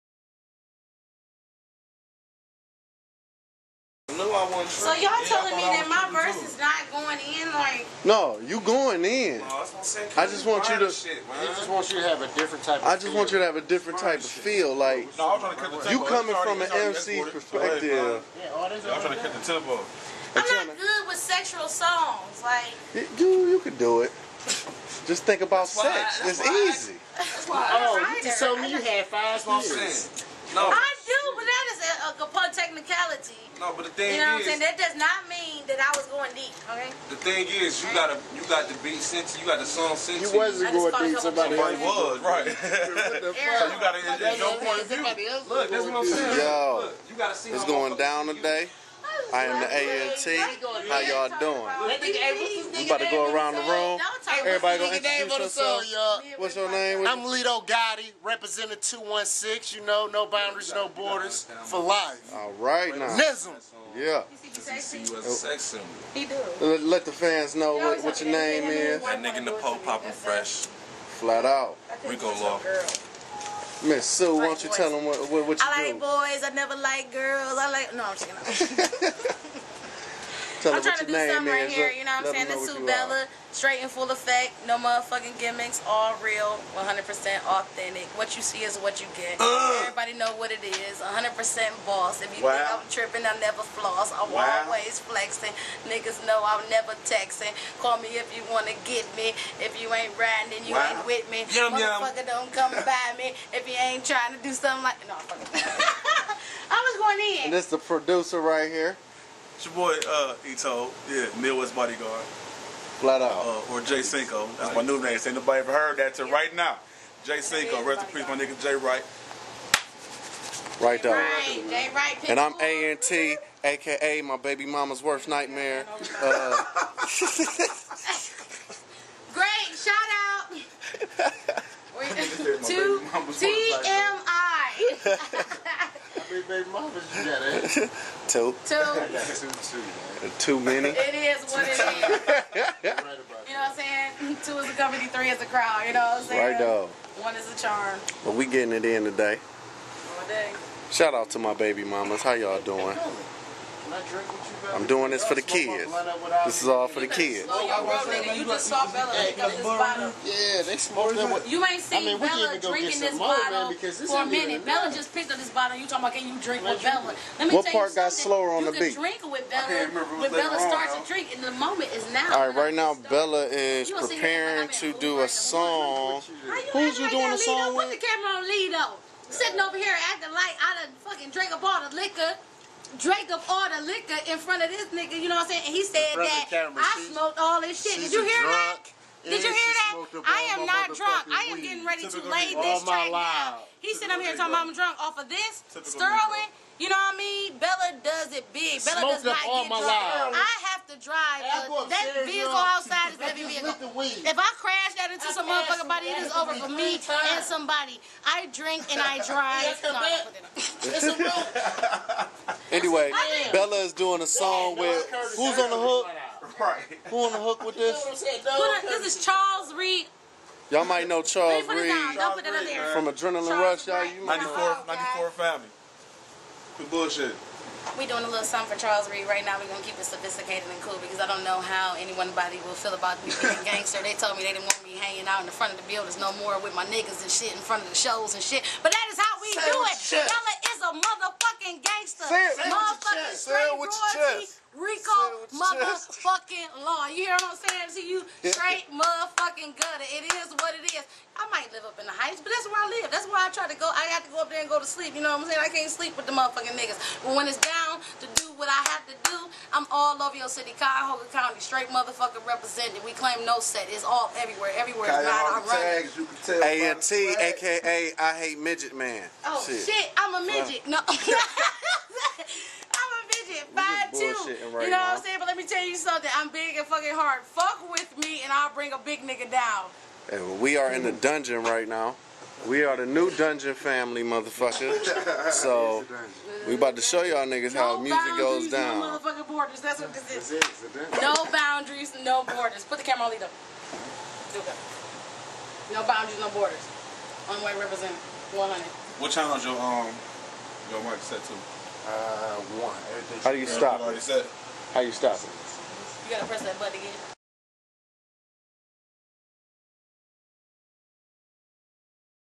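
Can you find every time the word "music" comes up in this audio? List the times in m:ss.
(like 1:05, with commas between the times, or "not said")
4:47.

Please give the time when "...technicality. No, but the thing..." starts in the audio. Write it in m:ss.
0:32.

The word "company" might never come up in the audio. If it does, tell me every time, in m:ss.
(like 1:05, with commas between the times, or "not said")
2:24.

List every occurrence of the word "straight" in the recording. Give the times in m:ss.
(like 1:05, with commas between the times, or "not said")
1:23, 4:08, 4:21.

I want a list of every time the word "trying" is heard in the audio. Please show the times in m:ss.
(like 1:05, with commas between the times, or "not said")
0:18, 1:20, 1:44.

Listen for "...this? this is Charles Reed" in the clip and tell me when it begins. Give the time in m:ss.
3:37.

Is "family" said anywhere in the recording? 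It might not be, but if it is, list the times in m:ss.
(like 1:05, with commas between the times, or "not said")
3:45, 4:43.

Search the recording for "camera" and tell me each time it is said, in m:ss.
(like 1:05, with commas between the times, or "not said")
2:58, 3:06, 4:53.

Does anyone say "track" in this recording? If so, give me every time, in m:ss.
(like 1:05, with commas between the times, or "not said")
3:12.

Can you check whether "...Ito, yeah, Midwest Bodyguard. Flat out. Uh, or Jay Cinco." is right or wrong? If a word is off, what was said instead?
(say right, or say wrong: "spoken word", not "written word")
right.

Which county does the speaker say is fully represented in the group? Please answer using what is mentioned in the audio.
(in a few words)
Cuyahoga County.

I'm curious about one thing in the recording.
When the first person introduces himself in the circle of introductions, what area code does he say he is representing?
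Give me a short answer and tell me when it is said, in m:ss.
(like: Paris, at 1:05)
216, at 0:58.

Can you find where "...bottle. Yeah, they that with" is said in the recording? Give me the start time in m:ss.
2:39.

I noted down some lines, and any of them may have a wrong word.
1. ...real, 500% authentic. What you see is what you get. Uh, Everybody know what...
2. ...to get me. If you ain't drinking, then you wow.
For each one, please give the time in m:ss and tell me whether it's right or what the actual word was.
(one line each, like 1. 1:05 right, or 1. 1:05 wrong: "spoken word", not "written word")
1. 1:26 wrong: "100", not "500"
2. 1:38 wrong: "riding", not "drinking".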